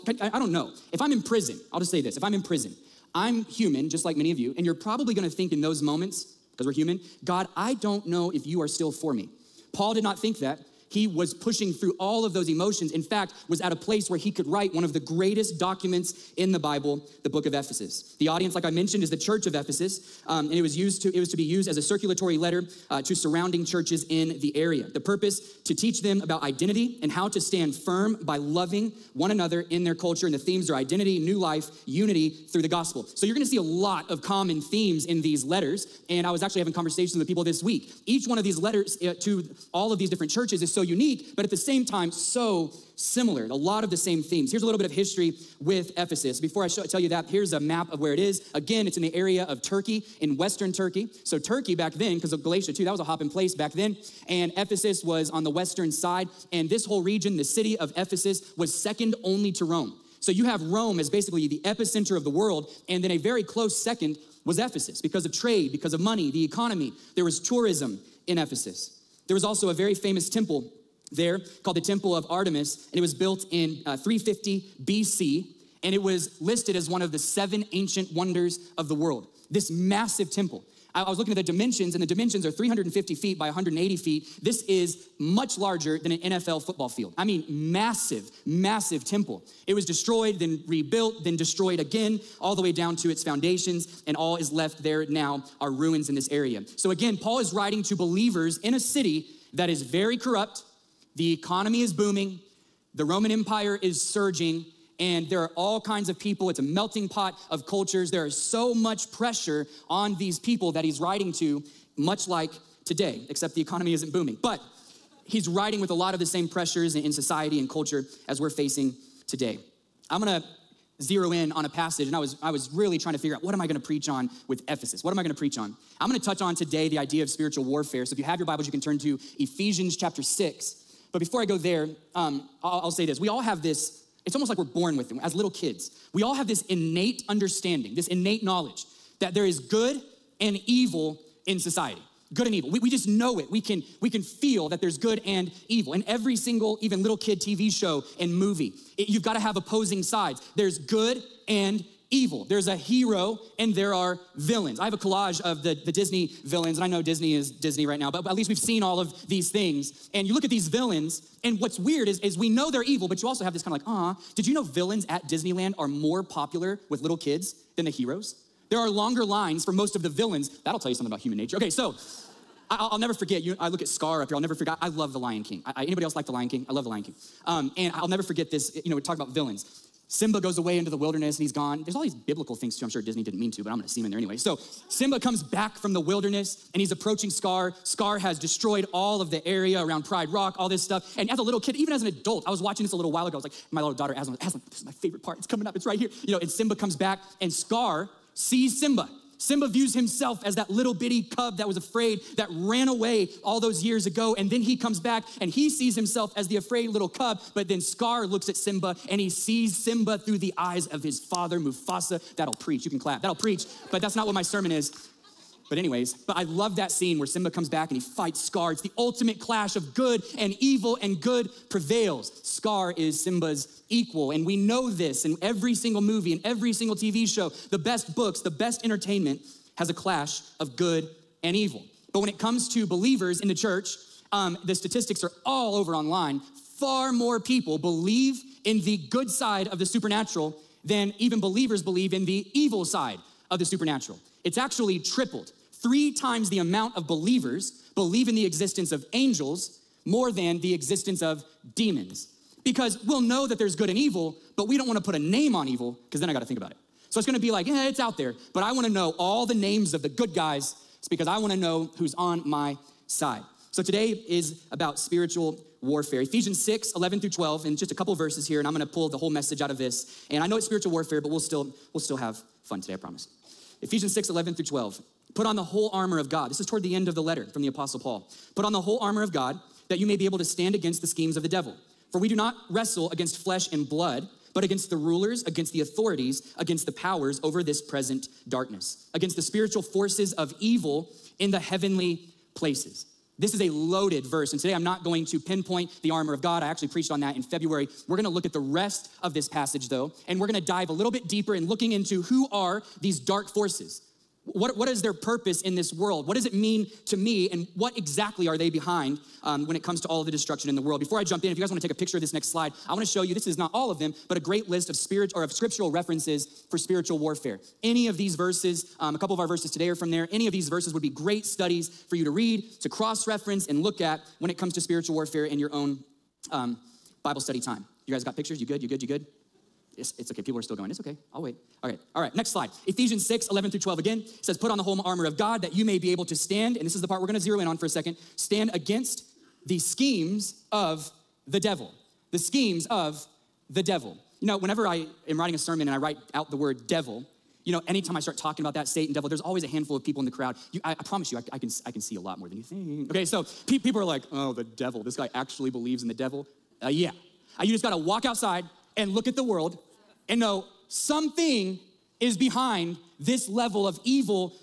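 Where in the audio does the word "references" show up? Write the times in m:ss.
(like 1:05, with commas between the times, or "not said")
5:15, 5:23.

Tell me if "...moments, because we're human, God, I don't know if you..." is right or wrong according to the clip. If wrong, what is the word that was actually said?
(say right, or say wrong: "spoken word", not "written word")
right.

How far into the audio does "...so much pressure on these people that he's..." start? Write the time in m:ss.
1:48.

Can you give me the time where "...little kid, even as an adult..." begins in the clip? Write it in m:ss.
3:11.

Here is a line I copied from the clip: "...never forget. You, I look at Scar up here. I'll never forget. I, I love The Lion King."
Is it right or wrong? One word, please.
right.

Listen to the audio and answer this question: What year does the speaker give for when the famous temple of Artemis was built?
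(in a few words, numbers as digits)
350 BC.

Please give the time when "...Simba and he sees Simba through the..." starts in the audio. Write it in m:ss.
3:28.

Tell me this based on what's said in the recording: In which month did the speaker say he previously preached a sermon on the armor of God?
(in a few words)
February.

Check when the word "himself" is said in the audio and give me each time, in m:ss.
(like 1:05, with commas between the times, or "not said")
3:19, 3:25.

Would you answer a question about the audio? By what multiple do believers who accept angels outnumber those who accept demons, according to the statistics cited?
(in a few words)
3 times.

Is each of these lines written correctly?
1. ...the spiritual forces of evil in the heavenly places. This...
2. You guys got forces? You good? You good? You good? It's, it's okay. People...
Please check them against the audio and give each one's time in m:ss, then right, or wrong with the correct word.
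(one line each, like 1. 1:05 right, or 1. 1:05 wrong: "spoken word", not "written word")
1. 4:49 right
2. 5:28 wrong: "pictures", not "forces".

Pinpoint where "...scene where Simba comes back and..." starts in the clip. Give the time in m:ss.
3:36.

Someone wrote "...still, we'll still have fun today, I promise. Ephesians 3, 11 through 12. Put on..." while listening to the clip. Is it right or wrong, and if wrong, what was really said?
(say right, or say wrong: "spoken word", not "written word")
wrong: "6", not "3".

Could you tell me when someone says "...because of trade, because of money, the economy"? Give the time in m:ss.
1:04.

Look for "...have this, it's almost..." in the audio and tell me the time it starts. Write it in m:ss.
2:13.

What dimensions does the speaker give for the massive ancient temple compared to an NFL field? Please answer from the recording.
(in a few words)
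350 by 180 feet.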